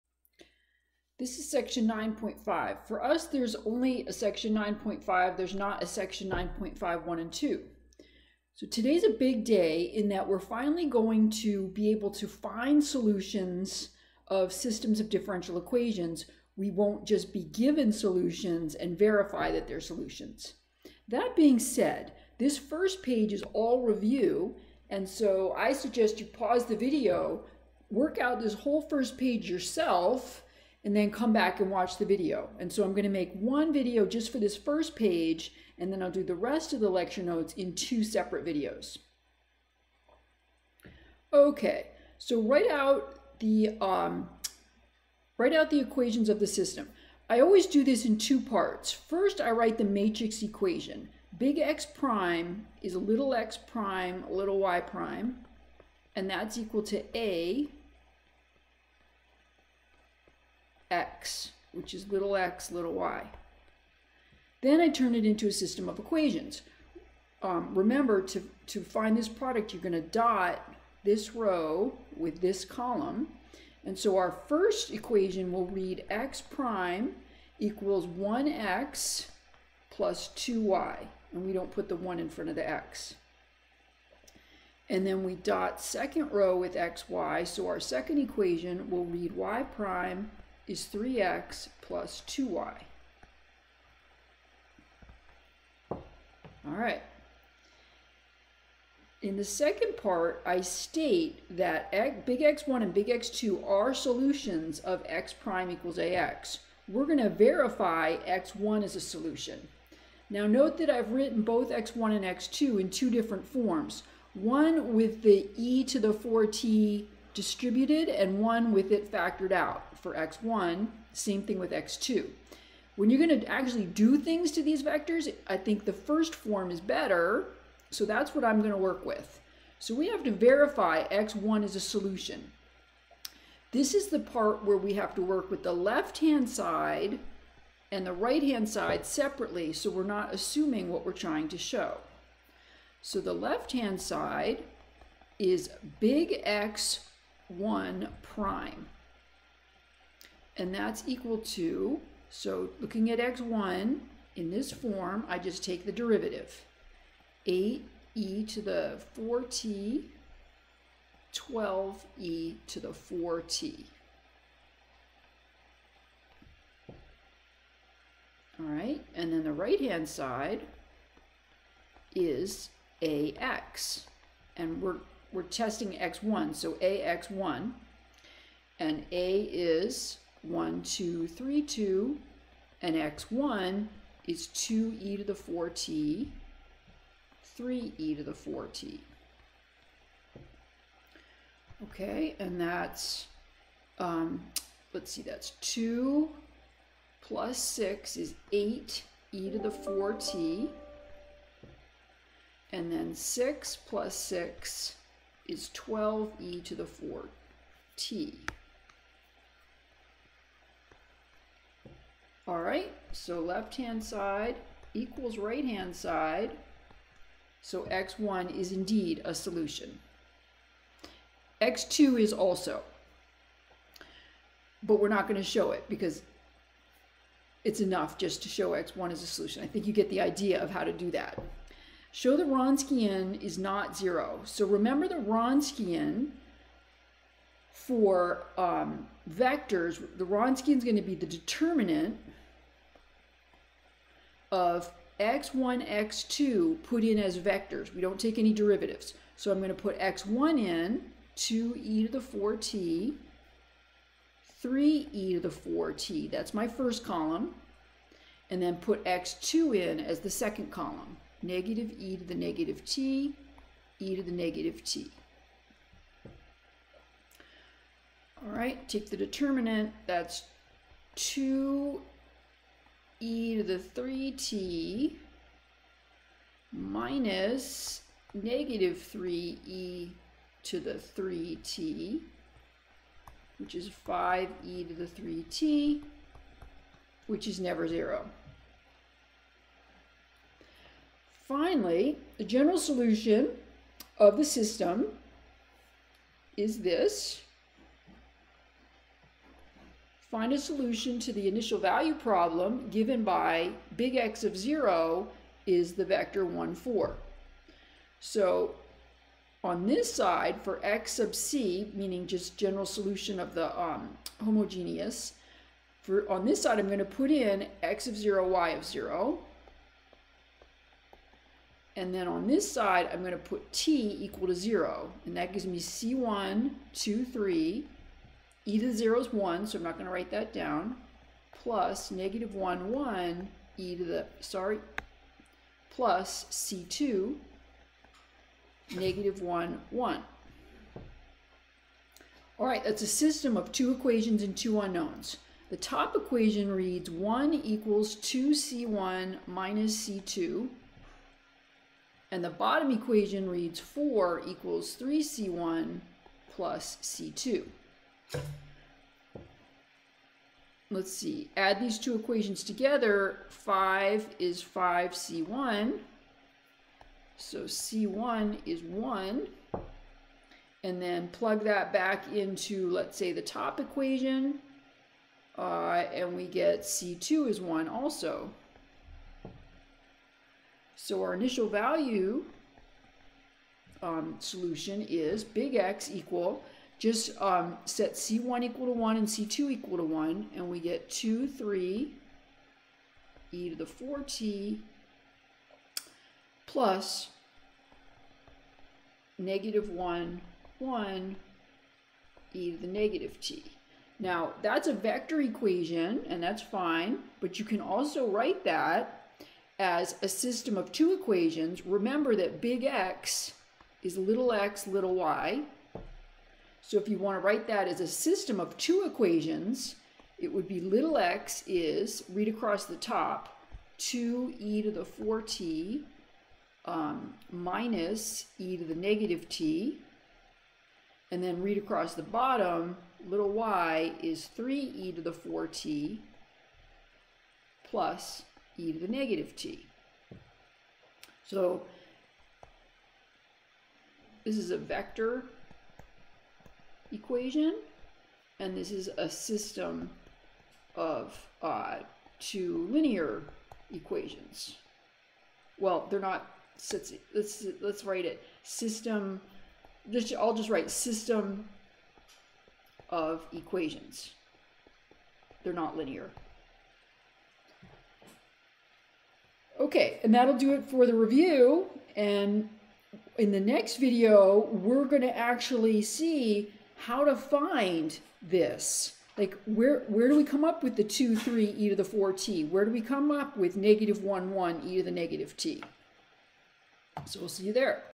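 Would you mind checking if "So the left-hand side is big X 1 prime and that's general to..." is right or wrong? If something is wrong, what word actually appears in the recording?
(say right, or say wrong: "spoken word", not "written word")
wrong: "equal", not "general".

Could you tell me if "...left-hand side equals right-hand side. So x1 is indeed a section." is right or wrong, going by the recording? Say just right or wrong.
wrong.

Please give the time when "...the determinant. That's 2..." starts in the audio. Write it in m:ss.
4:29.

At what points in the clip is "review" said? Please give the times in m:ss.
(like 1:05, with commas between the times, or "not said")
0:23, 7:51.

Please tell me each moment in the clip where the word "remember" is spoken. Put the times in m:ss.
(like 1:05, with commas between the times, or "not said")
1:07, 3:54, 6:51.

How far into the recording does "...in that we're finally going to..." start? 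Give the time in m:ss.
0:09.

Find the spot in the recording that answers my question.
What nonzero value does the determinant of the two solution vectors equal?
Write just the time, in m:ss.
4:44.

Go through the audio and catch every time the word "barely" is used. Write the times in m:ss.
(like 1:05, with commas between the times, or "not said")
not said.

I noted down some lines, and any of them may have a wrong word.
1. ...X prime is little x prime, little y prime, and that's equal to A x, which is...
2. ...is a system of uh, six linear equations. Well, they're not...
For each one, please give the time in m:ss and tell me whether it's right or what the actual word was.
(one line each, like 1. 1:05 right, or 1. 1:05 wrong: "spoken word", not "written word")
1. 0:51 right
2. 7:28 wrong: "two", not "six".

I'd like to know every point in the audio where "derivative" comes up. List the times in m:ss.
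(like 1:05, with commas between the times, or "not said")
2:35, 4:08.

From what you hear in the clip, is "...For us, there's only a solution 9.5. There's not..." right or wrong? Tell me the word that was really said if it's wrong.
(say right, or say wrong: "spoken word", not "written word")
wrong: "section", not "solution".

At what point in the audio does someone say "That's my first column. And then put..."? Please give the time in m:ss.
4:16.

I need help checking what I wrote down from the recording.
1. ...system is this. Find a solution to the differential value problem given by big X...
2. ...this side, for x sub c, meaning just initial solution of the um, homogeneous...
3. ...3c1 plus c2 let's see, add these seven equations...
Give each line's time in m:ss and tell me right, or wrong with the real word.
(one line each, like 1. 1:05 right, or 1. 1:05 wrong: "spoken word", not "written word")
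1. 4:54 wrong: "initial", not "differential"
2. 5:09 wrong: "general", not "initial"
3. 5:55 wrong: "two", not "seven".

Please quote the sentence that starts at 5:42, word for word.
All right, that's a system of two equations and two unknowns.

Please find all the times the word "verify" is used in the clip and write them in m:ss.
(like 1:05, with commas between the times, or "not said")
0:18, 1:47, 2:10.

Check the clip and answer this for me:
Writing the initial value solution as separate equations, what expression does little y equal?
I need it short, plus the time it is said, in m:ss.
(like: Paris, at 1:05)
3e^(4t) + e^(-t), at 7:14.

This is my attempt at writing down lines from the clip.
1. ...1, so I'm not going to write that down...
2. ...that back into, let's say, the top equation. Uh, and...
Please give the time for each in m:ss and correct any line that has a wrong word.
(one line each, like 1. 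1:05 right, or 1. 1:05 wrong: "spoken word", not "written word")
1. 5:29 right
2. 6:11 right.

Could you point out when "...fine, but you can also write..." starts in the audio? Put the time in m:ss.
6:46.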